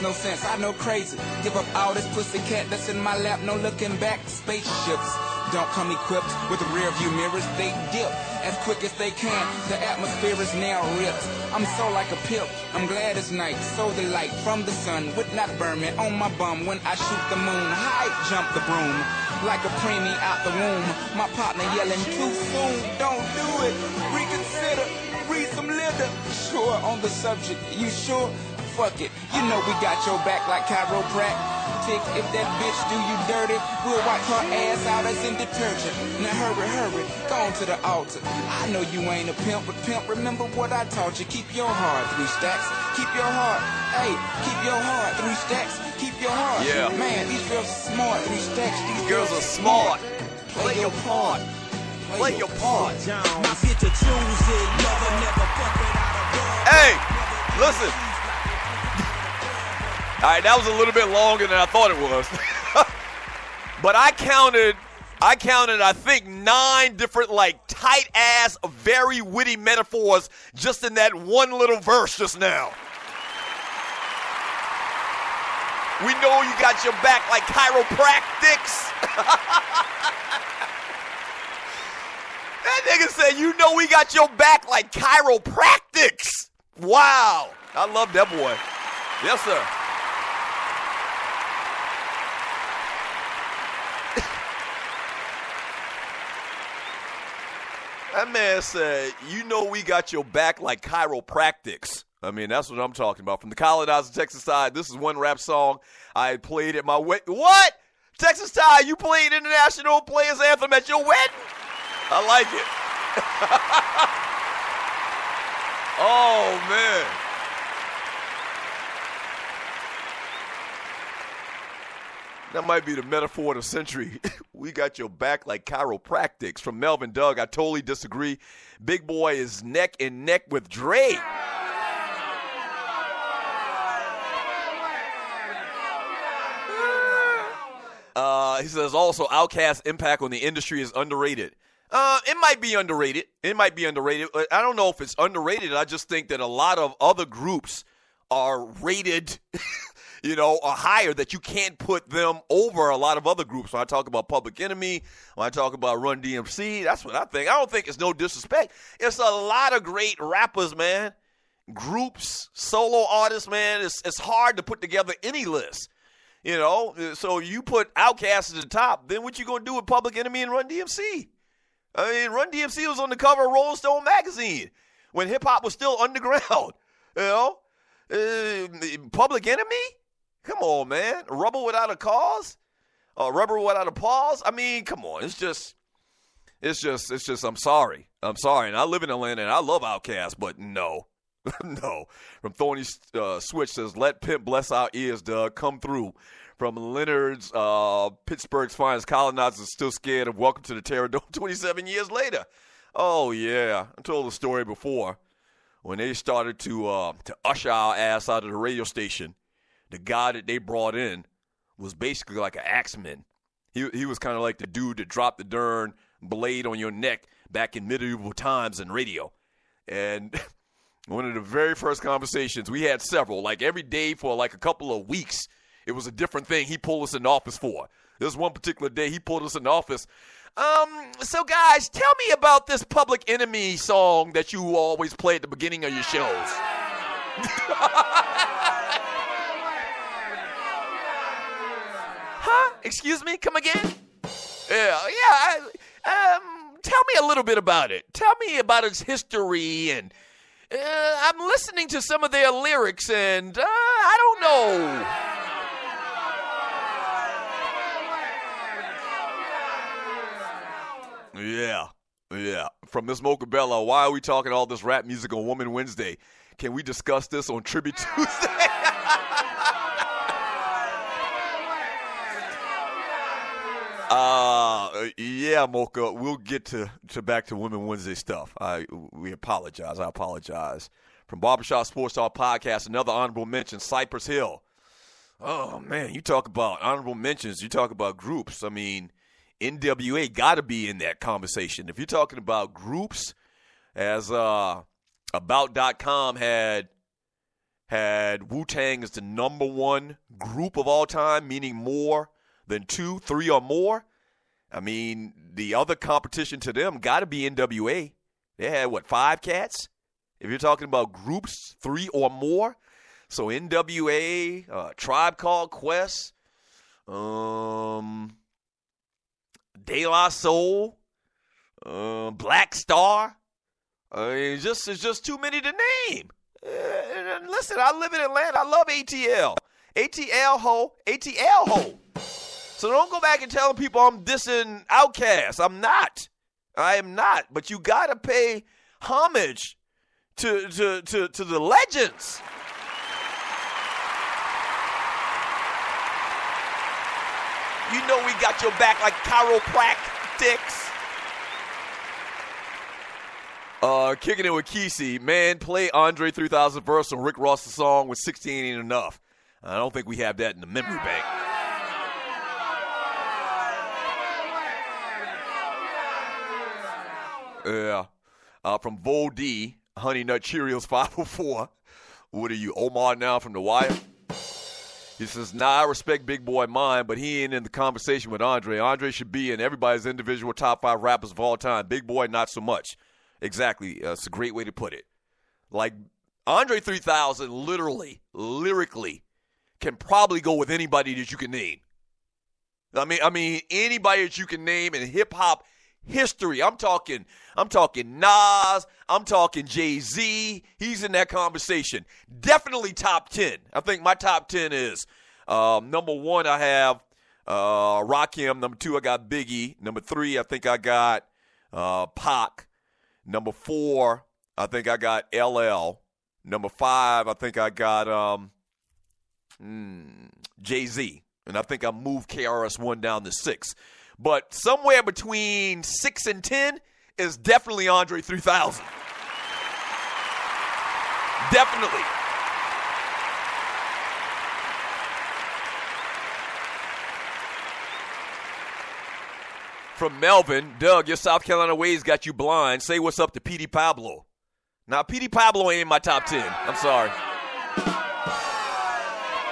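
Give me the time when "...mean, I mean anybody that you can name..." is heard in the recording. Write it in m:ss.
6:33.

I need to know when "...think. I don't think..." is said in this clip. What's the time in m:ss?
2:37.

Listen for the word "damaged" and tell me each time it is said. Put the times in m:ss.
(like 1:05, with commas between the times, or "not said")
not said.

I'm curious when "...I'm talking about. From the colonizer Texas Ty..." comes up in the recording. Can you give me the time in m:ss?
1:42.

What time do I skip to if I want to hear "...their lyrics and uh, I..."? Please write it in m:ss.
4:12.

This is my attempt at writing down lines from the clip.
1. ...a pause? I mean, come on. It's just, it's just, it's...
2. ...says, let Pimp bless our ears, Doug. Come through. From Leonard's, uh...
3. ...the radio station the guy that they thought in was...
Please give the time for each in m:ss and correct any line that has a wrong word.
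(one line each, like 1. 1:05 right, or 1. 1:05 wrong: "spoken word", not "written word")
1. 3:03 right
2. 3:13 right
3. 3:28 wrong: "brought", not "thought".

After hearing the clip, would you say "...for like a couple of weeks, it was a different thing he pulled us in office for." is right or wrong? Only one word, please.
right.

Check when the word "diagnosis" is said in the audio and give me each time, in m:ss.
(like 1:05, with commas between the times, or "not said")
not said.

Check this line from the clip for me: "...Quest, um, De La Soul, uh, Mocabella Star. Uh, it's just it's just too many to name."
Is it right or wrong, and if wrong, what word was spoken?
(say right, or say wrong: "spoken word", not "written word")
wrong: "Black", not "Mocabella".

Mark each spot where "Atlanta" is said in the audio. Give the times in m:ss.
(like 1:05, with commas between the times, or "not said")
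3:09, 5:28.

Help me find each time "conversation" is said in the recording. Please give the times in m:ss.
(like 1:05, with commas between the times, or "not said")
3:42, 4:51, 6:17, 6:41.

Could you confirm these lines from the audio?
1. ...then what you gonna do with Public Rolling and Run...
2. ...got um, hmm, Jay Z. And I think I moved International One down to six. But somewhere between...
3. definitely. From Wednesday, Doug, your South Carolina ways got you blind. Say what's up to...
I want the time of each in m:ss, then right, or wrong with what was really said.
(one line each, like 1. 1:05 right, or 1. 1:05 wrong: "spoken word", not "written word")
1. 2:49 wrong: "Enemy", not "Rolling"
2. 6:57 wrong: "KRS", not "International"
3. 7:11 wrong: "Melvin", not "Wednesday".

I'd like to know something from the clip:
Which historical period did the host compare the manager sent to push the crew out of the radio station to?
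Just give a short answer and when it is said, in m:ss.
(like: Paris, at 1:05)
medieval times, at 3:37.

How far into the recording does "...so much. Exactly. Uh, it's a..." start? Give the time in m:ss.
6:22.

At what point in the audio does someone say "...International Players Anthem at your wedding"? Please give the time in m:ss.
1:49.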